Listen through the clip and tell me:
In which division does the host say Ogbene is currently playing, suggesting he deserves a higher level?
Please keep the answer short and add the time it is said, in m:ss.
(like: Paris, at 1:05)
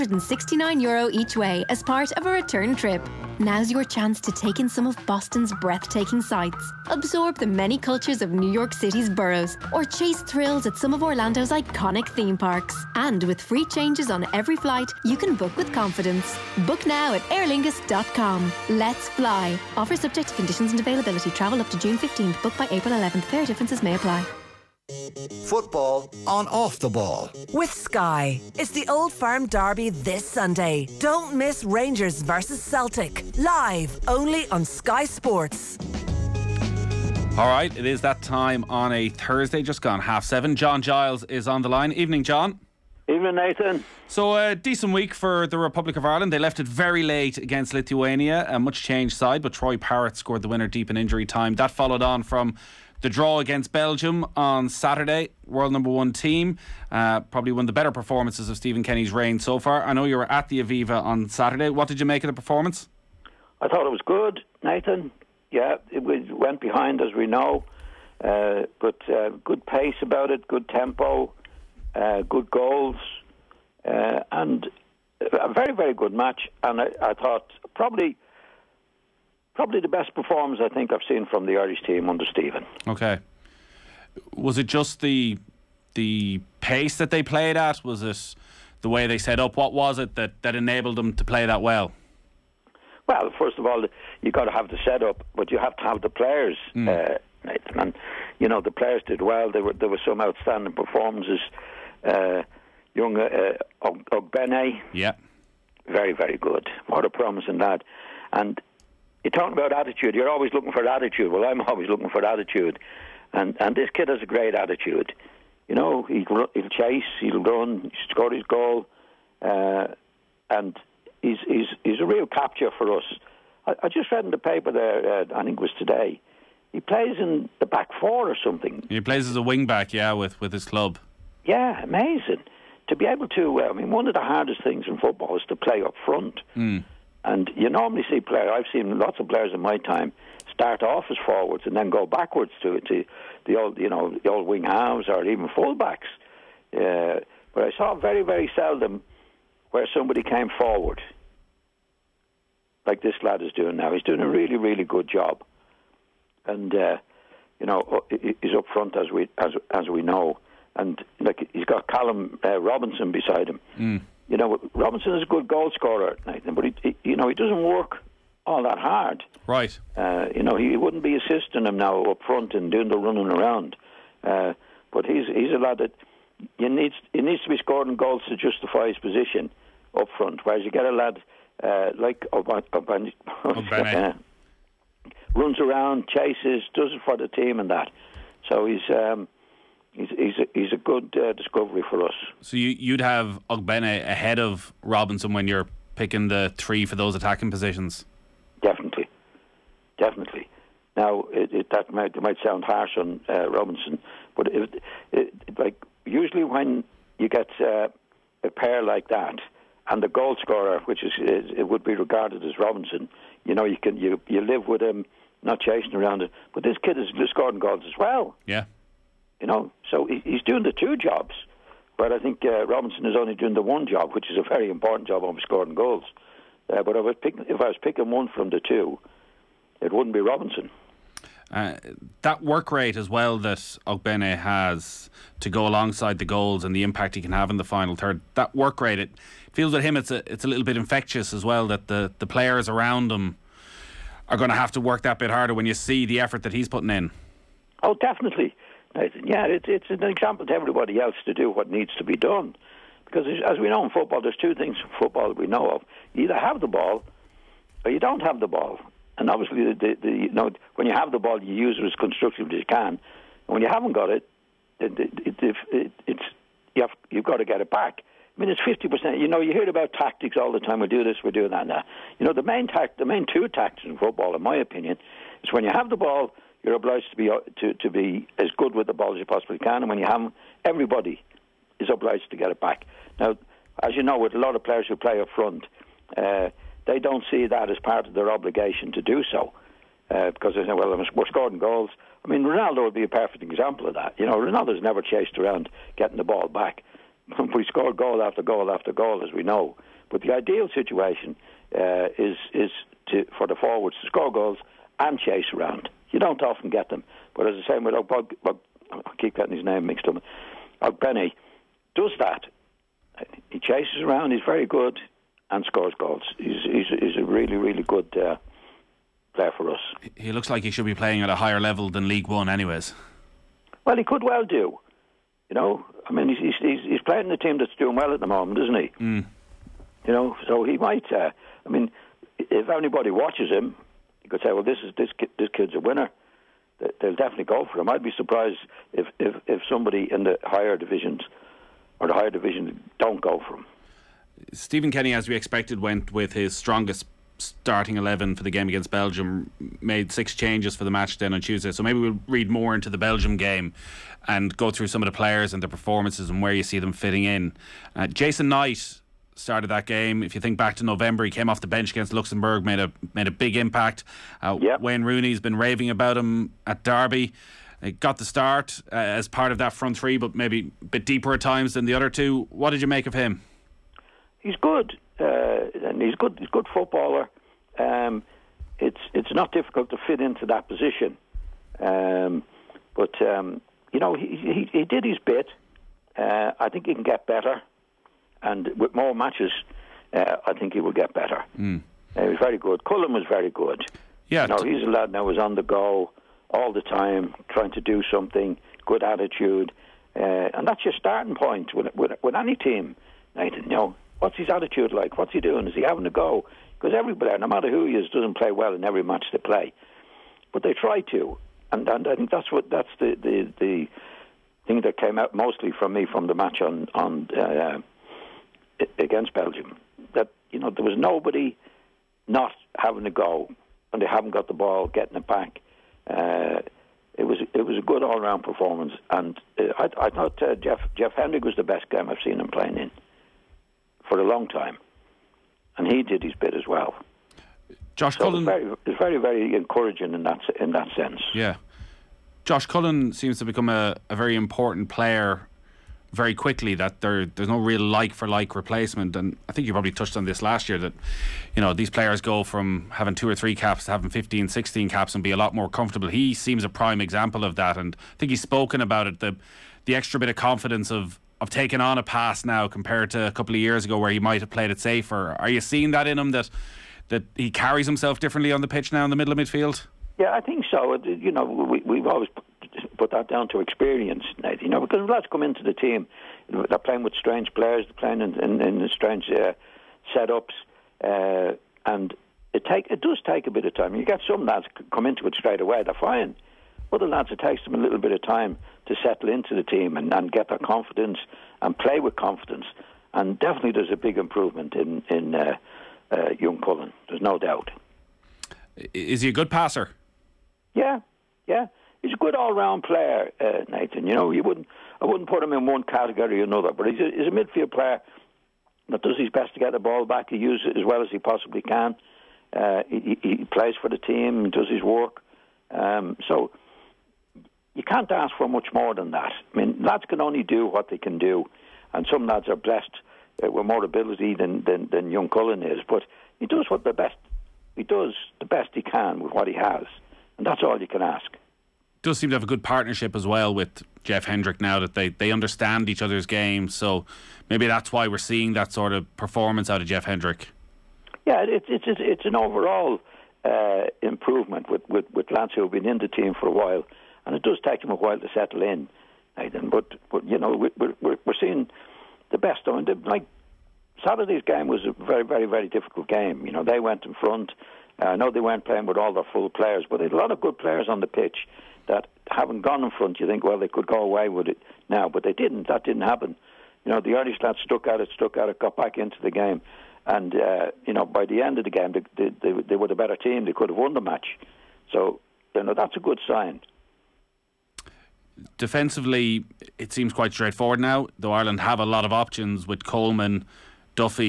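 League One, at 5:22.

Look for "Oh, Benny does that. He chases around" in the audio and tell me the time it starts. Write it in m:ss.
5:10.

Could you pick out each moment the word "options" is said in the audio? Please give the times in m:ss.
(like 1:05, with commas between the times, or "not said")
9:42.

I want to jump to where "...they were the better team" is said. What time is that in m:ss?
9:32.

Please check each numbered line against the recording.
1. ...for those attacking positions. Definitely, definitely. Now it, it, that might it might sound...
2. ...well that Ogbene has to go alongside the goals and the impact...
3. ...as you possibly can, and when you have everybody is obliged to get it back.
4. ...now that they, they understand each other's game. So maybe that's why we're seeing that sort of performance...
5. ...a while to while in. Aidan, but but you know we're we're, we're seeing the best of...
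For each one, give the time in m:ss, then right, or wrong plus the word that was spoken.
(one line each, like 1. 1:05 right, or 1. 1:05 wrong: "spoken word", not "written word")
1. 3:16 right
2. 3:53 right
3. 4:39 right
4. 8:54 right
5. 9:07 wrong: "settle", not "while".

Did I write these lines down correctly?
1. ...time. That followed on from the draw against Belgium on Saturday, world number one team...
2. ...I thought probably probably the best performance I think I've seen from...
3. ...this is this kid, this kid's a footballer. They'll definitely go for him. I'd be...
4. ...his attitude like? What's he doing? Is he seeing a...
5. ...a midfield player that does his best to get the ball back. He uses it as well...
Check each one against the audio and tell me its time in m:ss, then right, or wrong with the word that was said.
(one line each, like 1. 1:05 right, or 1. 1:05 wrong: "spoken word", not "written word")
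1. 0:51 right
2. 1:17 right
3. 5:34 wrong: "winner", not "footballer"
4. 6:44 wrong: "having", not "seeing"
5. 8:27 right.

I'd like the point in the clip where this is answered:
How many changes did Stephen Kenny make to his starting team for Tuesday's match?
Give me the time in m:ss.
5:50.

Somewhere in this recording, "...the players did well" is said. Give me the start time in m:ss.
1:38.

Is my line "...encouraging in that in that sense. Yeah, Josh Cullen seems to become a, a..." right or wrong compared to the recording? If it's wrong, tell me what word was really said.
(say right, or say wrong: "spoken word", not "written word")
right.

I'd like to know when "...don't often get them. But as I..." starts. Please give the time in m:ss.
5:06.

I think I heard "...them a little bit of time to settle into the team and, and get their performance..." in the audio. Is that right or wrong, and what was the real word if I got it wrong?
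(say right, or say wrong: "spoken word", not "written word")
wrong: "confidence", not "performance".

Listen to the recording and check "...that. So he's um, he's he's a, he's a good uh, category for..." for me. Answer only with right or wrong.
wrong.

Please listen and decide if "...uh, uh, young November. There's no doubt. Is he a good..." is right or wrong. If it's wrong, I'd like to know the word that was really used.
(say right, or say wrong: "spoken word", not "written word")
wrong: "Cullen", not "November".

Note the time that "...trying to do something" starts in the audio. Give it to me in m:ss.
6:37.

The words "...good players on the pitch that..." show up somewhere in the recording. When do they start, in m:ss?
9:20.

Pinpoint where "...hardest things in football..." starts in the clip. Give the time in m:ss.
2:14.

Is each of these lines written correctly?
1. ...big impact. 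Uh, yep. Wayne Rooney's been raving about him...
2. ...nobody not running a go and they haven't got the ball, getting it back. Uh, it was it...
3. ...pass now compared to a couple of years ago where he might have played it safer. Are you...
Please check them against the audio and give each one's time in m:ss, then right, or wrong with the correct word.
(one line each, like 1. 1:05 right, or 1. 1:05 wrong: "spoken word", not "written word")
1. 6:03 right
2. 7:00 wrong: "having", not "running"
3. 7:42 right.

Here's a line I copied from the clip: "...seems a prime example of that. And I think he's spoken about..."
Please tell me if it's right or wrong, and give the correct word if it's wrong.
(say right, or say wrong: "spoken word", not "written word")
right.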